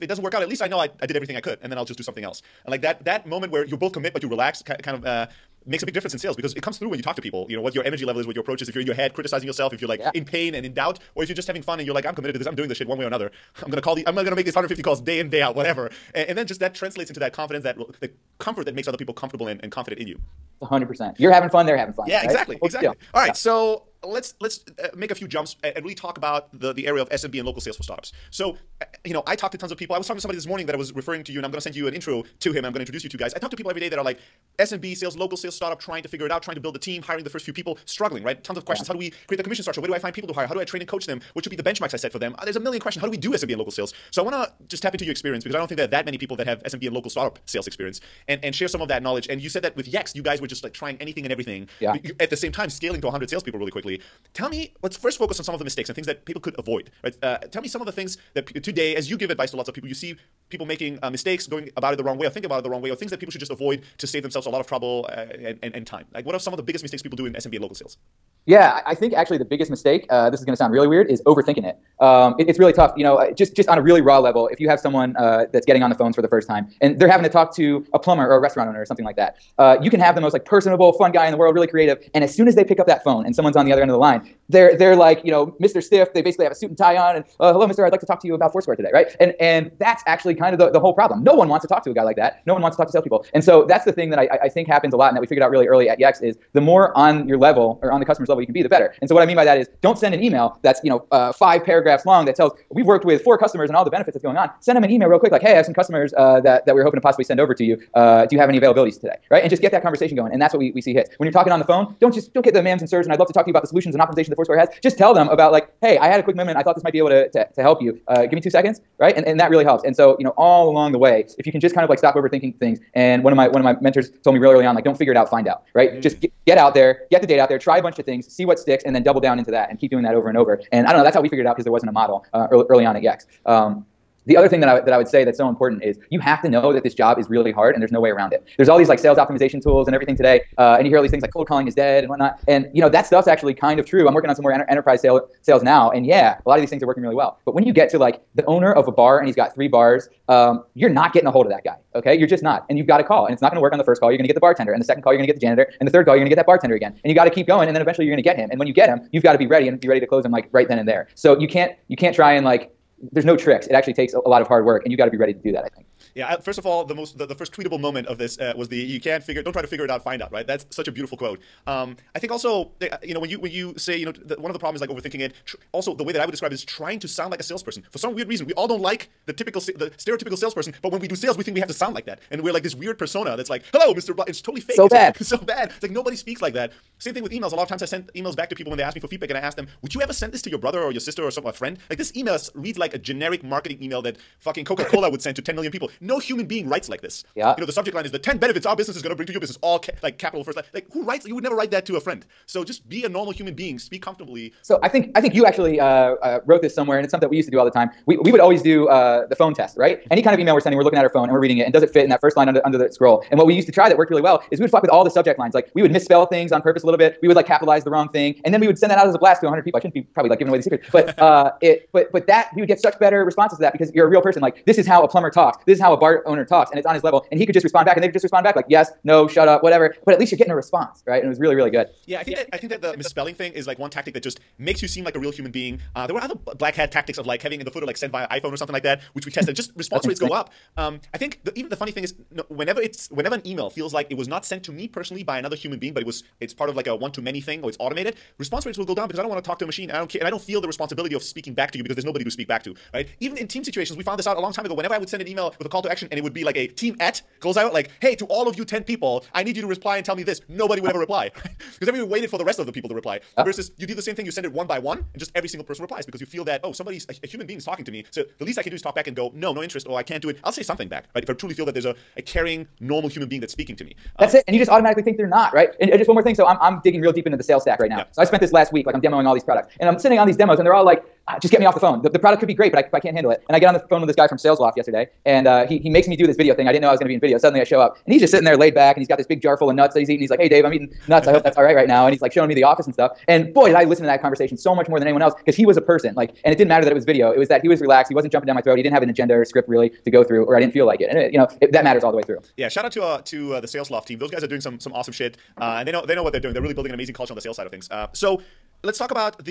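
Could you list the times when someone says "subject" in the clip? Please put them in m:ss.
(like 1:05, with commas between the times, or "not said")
3:17, 3:35.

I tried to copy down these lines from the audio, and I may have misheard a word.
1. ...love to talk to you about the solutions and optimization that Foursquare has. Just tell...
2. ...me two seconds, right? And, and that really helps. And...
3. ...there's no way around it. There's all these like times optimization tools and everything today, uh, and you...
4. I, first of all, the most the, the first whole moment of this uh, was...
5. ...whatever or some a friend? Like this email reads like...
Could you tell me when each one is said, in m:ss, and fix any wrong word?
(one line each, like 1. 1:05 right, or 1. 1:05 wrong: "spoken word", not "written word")
1. 1:53 right
2. 1:58 right
3. 2:17 wrong: "sales", not "times"
4. 2:46 wrong: "tweetable", not "whole"
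5. 3:10 wrong: "sister", not "whatever".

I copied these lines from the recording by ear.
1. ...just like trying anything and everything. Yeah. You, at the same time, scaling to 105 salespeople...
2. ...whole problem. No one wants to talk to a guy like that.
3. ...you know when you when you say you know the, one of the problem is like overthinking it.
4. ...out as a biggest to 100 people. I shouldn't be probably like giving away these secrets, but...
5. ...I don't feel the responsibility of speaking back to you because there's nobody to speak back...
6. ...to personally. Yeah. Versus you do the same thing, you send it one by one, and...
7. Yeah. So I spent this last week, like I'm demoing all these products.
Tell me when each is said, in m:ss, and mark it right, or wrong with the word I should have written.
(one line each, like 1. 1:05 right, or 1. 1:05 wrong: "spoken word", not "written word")
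1. 0:50 wrong: "100", not "105"
2. 1:30 right
3. 2:53 right
4. 3:38 wrong: "blast", not "biggest"
5. 4:10 right
6. 4:22 wrong: "reply", not "personally"
7. 4:37 right.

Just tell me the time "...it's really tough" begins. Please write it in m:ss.
1:12.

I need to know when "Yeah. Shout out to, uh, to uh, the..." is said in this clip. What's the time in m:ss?
5:02.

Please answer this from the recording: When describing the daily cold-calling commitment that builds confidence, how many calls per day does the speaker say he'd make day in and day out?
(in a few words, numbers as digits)
150.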